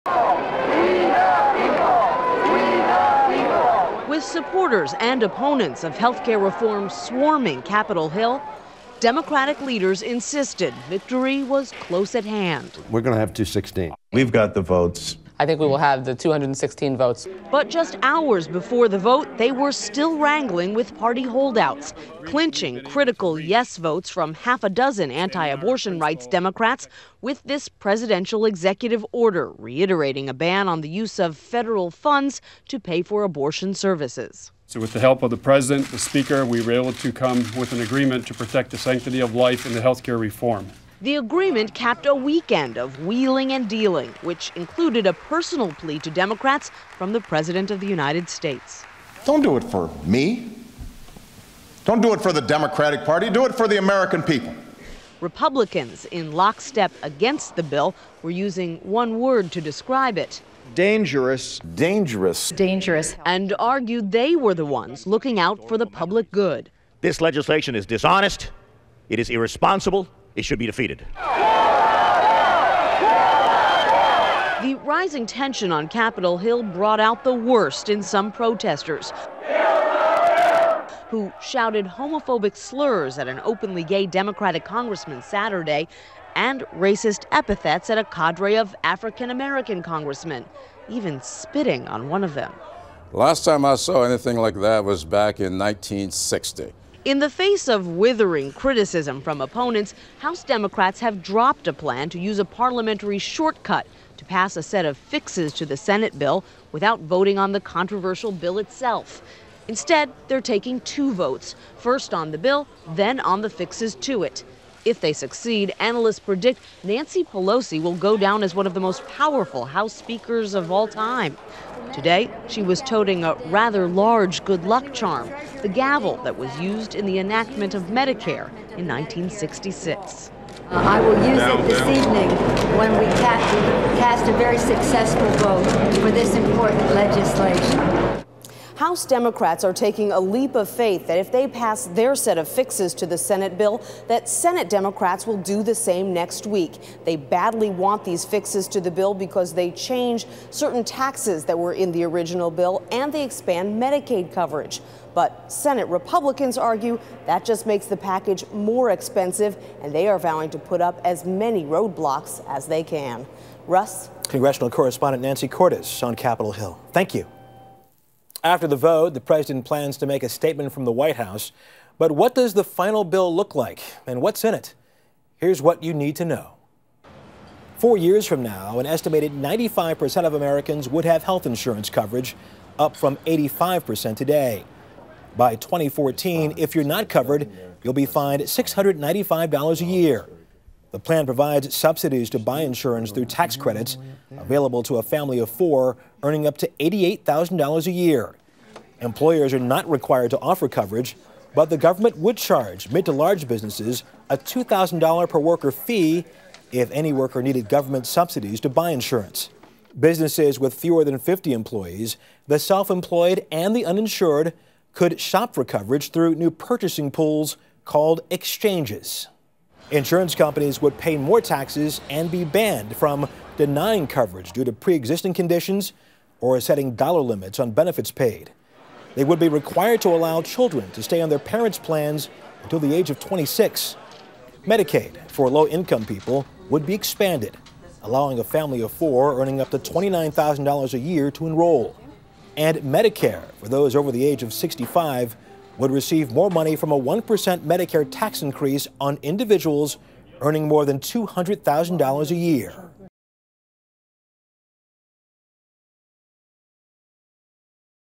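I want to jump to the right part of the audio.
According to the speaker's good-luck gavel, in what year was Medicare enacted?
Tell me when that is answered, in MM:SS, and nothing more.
02:08.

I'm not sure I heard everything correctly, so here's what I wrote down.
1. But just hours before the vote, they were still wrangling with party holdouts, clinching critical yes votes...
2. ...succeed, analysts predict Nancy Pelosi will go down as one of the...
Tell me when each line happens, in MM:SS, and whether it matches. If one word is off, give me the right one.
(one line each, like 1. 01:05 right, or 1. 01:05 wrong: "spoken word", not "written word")
1. 00:17 right
2. 01:55 right.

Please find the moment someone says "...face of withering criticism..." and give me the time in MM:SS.
01:37.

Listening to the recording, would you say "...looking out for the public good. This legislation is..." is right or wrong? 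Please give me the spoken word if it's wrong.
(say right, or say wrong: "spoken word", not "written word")
right.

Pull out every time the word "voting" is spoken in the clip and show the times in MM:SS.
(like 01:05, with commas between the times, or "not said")
01:46.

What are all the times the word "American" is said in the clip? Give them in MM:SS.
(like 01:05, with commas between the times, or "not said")
00:53, 01:29, 03:00.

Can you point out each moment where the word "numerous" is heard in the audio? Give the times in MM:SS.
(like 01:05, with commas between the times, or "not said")
not said.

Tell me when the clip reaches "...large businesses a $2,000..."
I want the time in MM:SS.
03:23.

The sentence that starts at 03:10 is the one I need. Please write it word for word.
The plan provides subsidies to buy insurance through tax credits available to a family of four earning up to $88,000 a year.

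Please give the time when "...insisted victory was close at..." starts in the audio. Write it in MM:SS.
00:10.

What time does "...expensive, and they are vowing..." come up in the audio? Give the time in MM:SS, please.
02:38.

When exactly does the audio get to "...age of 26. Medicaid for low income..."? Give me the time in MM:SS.
03:52.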